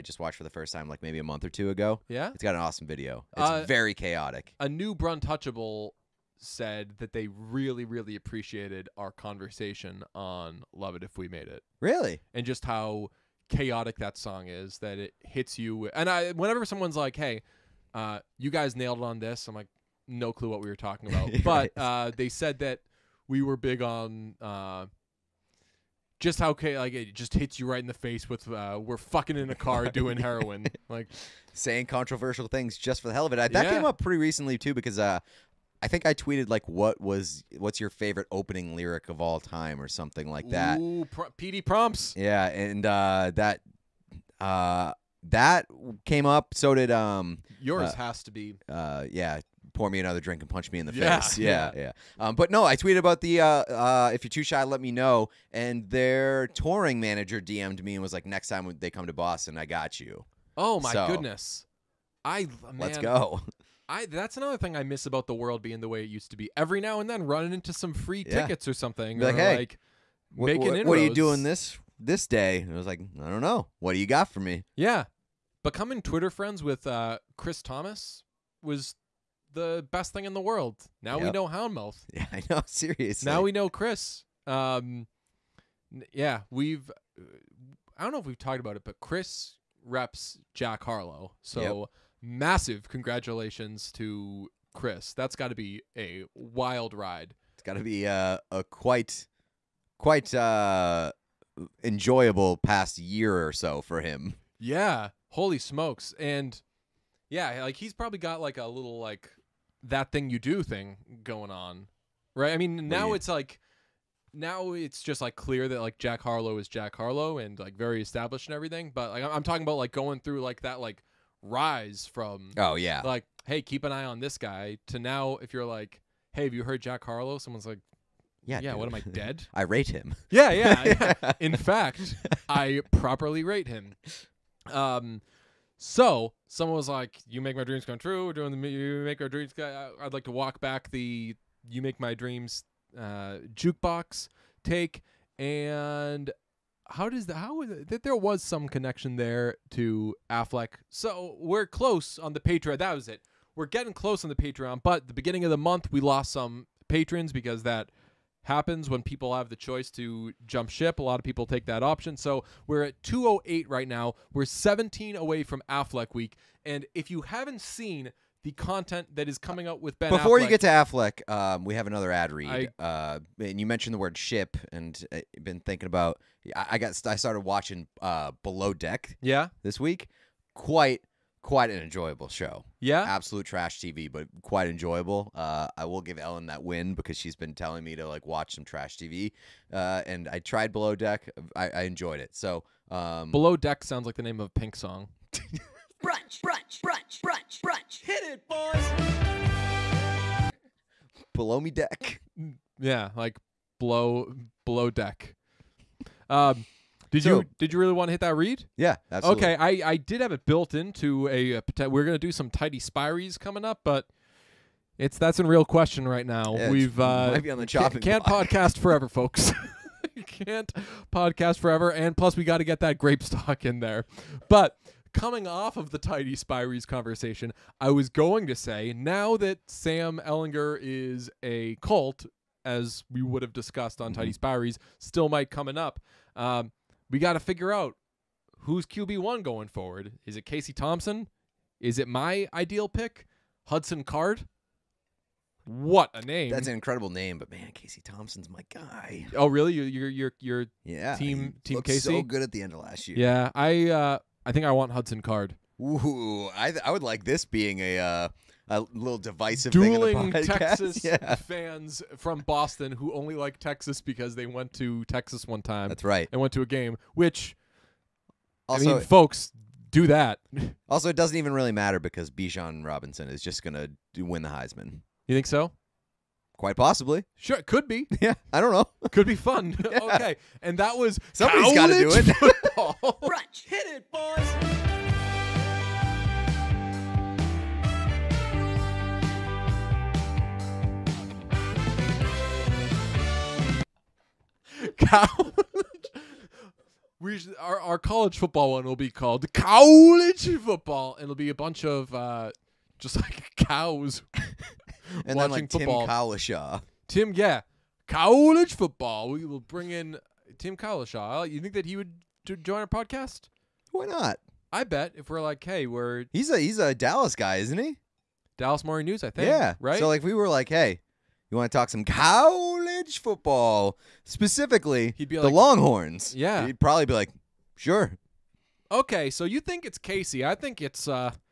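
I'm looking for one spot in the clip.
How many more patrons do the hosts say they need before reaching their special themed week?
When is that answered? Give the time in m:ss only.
2:44.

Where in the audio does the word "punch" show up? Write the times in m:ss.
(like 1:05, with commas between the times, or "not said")
0:50.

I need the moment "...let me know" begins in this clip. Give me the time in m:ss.
0:54.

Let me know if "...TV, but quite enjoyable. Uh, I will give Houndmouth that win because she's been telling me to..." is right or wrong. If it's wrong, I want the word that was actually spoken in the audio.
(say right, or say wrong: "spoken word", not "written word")
wrong: "Ellen", not "Houndmouth".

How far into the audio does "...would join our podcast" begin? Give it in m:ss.
5:11.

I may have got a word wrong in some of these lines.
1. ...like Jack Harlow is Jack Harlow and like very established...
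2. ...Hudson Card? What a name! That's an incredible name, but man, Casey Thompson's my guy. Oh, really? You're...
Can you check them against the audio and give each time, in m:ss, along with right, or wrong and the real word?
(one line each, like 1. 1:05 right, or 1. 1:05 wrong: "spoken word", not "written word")
1. 1:55 right
2. 4:03 right.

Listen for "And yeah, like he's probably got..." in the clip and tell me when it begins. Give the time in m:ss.
1:46.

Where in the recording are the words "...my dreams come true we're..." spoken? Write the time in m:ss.
2:17.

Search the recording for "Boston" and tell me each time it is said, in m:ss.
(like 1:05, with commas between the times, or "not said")
0:59, 4:22.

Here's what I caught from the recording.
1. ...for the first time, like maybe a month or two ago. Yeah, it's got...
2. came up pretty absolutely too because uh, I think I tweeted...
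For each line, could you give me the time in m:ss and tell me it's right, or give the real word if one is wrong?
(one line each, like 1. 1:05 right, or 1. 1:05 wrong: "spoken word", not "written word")
1. 0:00 right
2. 0:33 wrong: "recently", not "absolutely".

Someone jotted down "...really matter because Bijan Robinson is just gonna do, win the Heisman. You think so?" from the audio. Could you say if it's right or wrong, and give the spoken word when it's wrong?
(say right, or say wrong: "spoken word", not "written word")
right.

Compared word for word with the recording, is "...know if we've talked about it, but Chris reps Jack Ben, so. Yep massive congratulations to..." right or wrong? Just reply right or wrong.
wrong.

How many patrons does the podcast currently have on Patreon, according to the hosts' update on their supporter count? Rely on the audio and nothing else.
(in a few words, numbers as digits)
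208.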